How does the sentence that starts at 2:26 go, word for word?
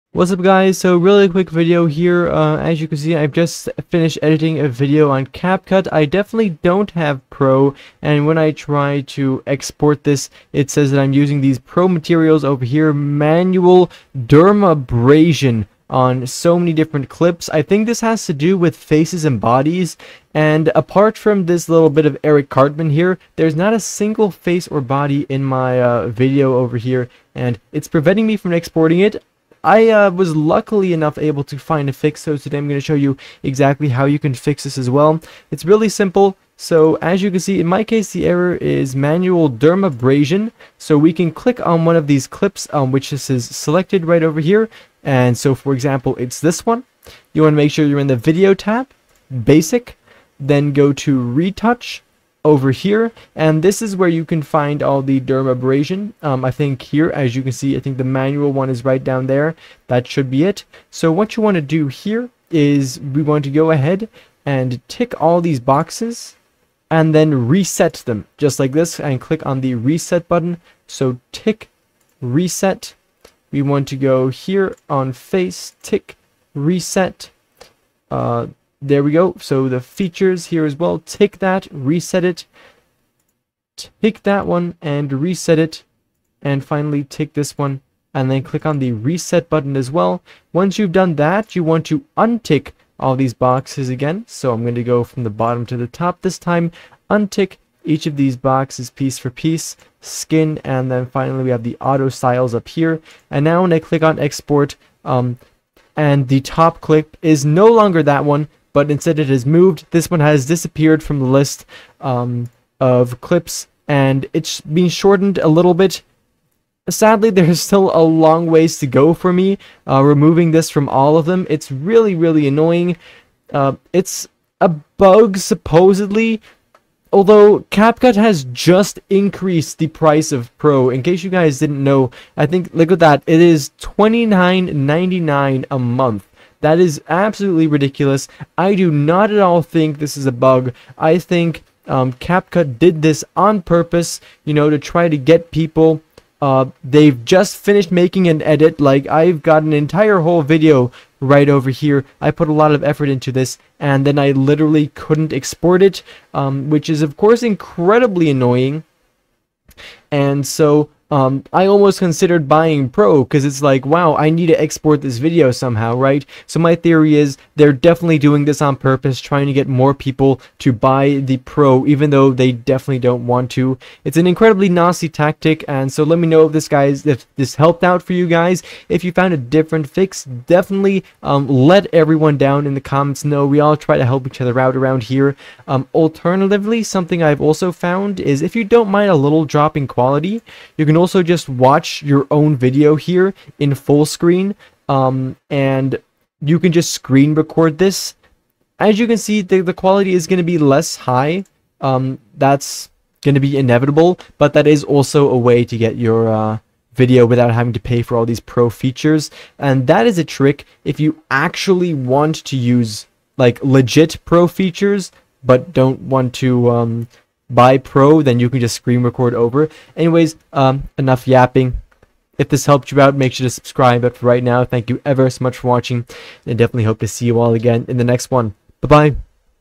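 Uh, they've just finished making an edit.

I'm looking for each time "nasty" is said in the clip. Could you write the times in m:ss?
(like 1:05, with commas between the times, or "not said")
2:54.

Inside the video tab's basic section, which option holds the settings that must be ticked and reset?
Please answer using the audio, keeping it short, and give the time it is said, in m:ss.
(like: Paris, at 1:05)
retouch, at 0:51.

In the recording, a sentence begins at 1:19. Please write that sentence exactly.
So the features here as well.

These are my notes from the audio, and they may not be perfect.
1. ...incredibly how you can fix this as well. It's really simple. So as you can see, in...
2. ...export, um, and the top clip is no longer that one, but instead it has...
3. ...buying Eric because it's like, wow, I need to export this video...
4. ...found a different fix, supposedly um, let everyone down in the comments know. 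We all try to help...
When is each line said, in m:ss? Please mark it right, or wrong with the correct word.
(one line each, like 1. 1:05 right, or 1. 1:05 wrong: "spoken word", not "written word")
1. 0:33 wrong: "exactly", not "incredibly"
2. 1:44 right
3. 2:42 wrong: "Pro", not "Eric"
4. 2:59 wrong: "definitely", not "supposedly".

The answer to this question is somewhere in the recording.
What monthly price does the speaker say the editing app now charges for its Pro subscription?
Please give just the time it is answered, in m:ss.
2:13.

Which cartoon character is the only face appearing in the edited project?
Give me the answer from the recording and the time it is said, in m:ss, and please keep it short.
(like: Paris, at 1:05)
Eric Cartman, at 0:22.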